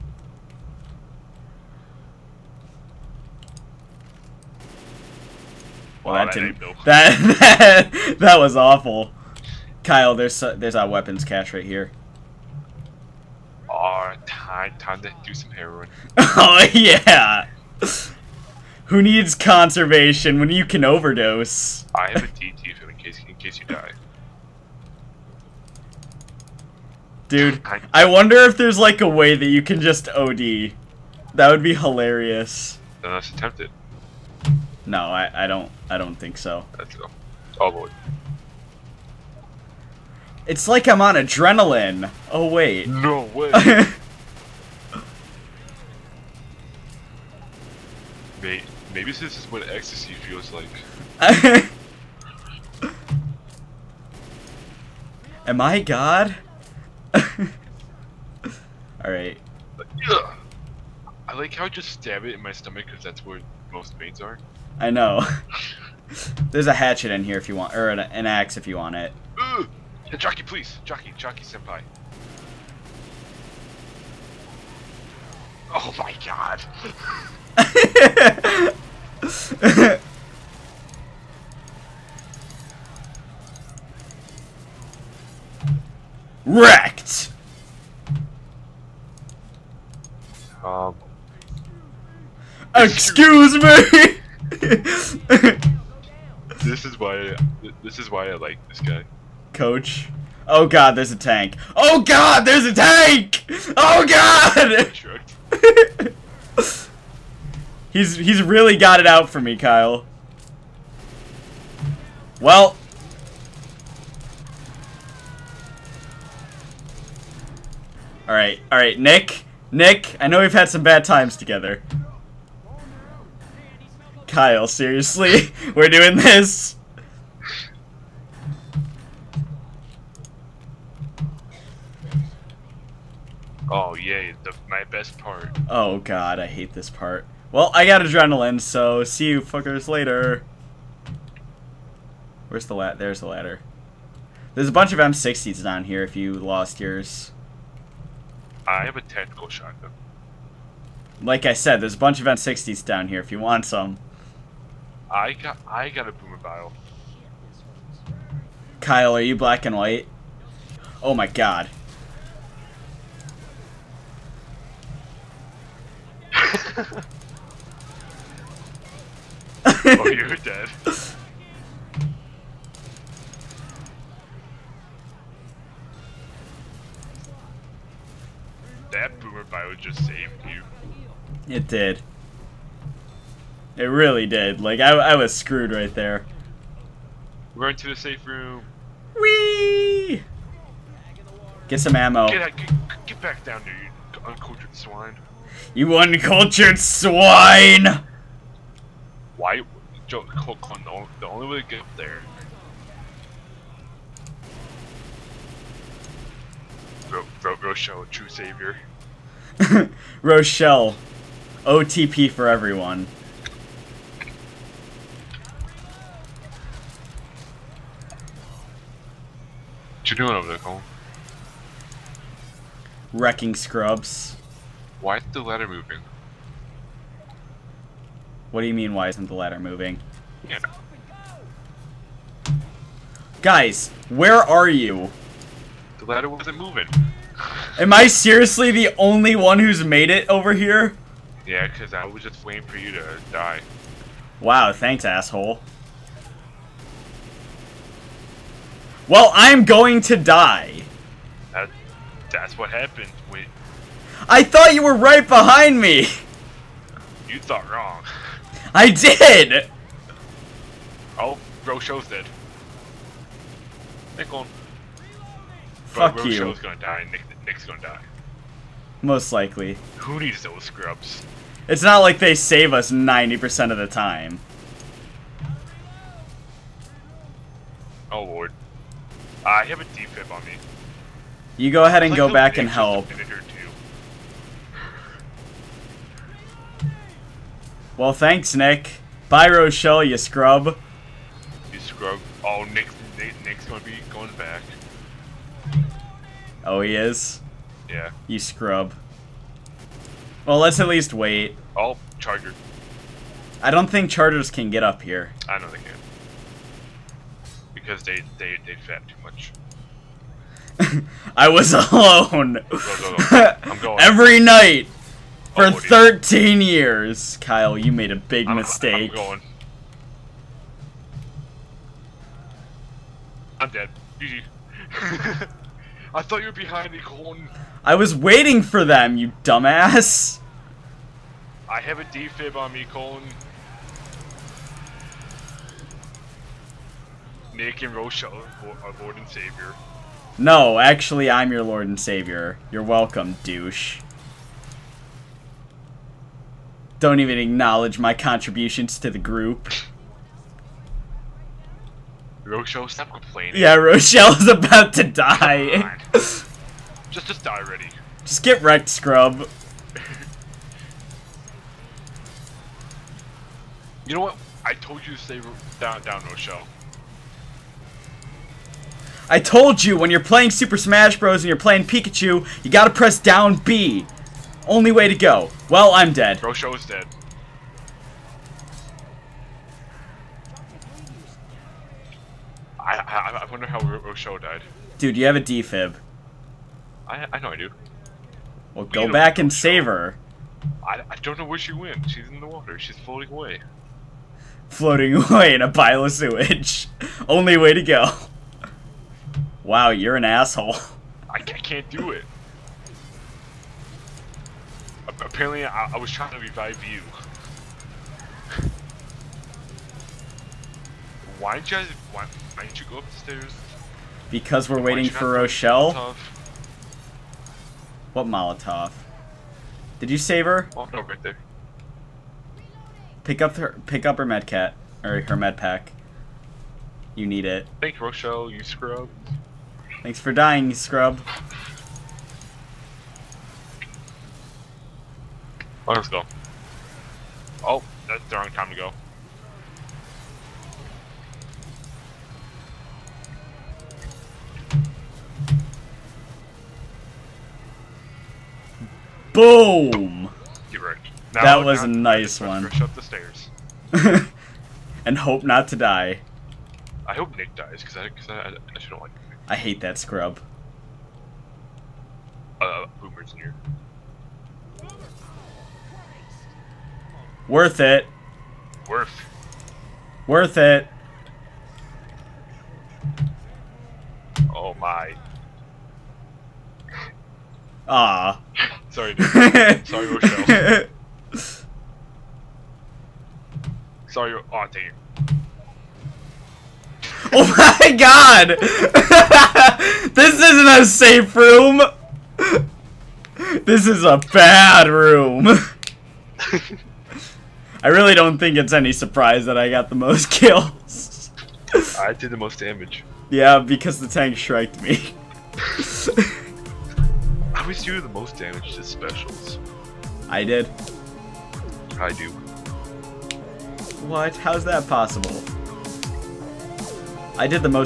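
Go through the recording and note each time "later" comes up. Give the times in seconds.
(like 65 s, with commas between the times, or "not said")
139 s.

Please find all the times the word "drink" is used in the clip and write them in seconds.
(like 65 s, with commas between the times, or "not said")
not said.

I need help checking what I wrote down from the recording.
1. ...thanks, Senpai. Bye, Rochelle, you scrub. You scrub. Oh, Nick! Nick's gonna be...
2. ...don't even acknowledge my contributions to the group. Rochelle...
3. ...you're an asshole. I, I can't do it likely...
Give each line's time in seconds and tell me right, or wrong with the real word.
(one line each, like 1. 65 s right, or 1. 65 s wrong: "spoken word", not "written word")
1. 288 s wrong: "Nick", not "Senpai"
2. 347 s right
3. 399 s wrong: "apparently", not "likely".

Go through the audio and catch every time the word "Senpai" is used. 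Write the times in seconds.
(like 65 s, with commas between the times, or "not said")
71 s.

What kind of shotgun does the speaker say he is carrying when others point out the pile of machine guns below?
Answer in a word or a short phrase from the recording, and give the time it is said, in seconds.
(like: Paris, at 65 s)
tactical shotgun, at 149 s.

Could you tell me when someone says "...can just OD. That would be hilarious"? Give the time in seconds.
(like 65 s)
29 s.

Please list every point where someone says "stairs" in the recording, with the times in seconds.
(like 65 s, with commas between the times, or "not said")
413 s, 453 s.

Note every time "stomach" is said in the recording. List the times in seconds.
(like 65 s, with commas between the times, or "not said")
62 s.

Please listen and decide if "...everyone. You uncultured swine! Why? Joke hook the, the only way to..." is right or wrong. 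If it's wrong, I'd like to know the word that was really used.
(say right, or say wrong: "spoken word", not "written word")
wrong: "swine", not "everyone".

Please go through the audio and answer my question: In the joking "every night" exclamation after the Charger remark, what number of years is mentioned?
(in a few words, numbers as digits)
13 years.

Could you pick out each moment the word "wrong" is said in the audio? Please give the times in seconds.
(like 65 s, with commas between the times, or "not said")
257 s, 438 s.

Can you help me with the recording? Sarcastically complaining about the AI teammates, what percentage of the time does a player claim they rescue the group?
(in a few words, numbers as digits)
90%.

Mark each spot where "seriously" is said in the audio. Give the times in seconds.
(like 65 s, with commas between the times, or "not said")
124 s, 238 s.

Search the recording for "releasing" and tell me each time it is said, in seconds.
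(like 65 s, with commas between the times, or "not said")
not said.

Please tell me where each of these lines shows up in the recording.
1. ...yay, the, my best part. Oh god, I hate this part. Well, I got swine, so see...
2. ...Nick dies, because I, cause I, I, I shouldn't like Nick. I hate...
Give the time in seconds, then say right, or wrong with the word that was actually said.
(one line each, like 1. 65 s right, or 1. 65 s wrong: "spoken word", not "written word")
1. 133 s wrong: "adrenaline", not "swine"
2. 457 s right.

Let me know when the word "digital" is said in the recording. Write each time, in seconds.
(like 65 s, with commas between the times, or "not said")
not said.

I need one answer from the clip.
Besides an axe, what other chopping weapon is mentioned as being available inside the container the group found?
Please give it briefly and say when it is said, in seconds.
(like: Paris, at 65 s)
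hatchet, at 66 s.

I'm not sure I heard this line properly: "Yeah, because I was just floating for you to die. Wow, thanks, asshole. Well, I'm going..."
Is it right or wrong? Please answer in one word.
wrong.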